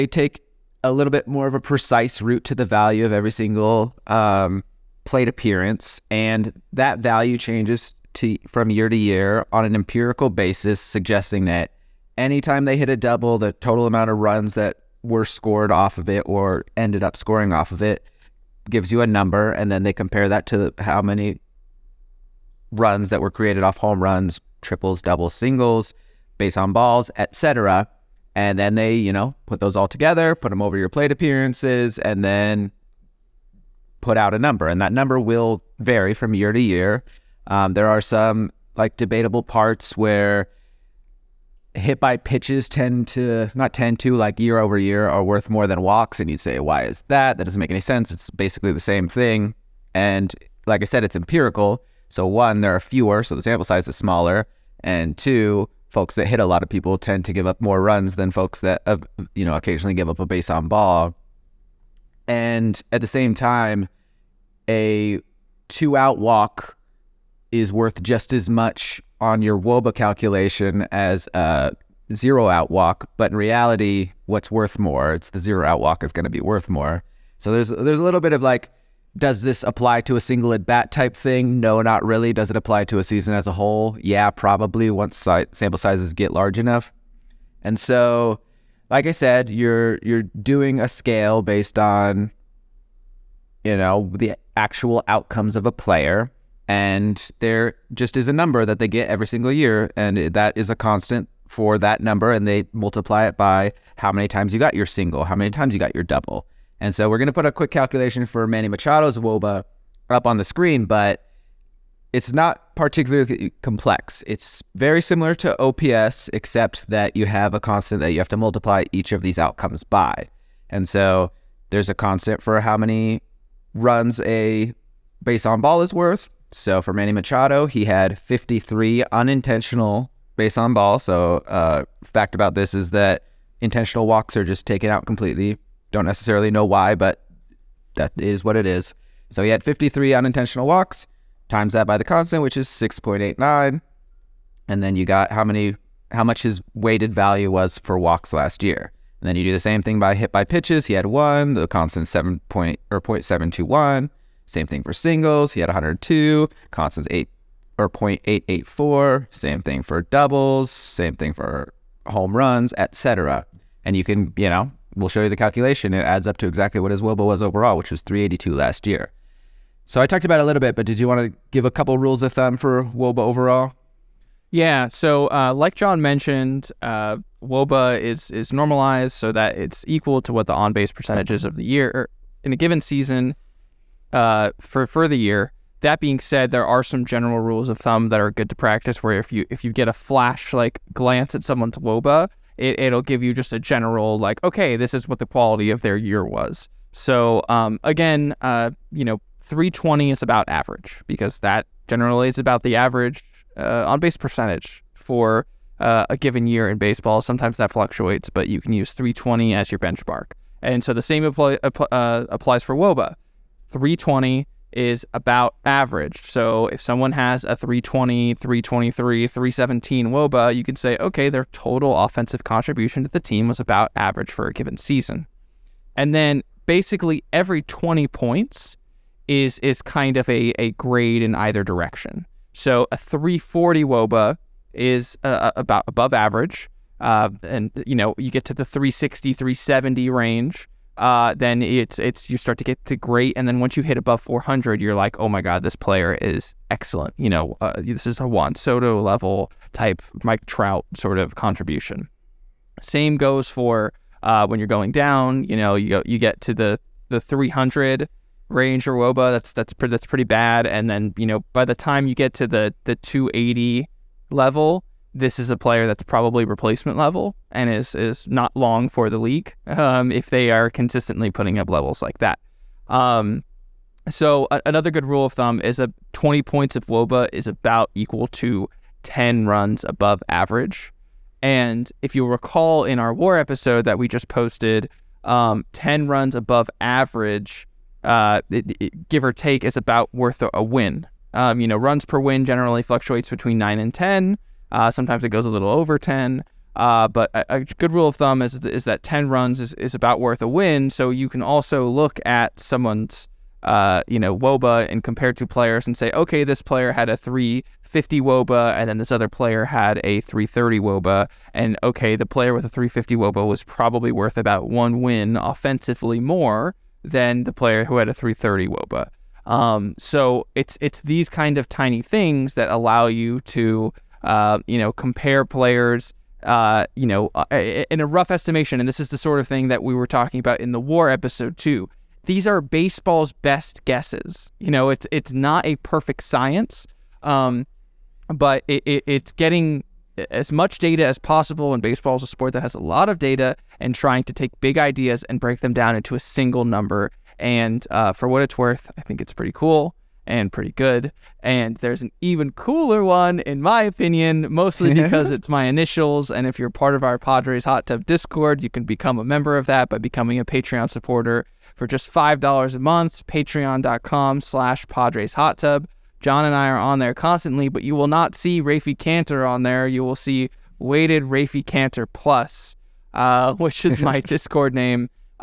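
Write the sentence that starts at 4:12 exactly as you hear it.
Same goes for uh, when you're going down.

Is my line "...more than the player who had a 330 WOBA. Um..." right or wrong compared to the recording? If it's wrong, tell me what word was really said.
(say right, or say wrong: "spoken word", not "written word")
right.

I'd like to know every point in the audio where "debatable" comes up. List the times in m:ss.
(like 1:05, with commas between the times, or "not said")
0:38.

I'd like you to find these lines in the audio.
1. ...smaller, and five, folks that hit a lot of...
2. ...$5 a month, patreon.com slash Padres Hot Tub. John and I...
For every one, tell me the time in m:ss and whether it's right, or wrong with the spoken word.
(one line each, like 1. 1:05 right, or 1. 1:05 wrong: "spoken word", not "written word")
1. 0:53 wrong: "two", not "five"
2. 6:02 right.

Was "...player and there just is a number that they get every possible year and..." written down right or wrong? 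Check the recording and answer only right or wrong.
wrong.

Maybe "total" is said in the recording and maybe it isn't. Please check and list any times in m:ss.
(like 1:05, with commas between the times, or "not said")
0:13, 3:41.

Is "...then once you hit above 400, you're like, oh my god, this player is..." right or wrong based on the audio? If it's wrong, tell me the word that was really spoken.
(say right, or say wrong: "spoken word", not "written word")
right.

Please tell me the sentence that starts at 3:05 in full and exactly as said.
That being said, there are some general rules of thumb that are good to practice.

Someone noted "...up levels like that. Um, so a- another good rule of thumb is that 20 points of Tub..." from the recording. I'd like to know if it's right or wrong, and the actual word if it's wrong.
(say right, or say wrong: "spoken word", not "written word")
wrong: "WOBA", not "Tub".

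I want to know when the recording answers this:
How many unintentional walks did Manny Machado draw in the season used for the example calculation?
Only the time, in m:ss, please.
2:08.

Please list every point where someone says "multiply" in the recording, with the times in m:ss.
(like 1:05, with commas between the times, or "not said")
1:42, 1:58.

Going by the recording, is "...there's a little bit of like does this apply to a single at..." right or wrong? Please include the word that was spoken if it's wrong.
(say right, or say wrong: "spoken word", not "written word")
right.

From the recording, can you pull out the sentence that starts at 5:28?
And this is the sort of thing that we were talking about in the war episode too.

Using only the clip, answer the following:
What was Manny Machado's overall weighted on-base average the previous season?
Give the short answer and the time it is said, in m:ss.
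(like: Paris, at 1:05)
382, at 2:48.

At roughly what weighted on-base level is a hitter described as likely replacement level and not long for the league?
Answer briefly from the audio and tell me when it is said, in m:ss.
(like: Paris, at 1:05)
280, at 4:22.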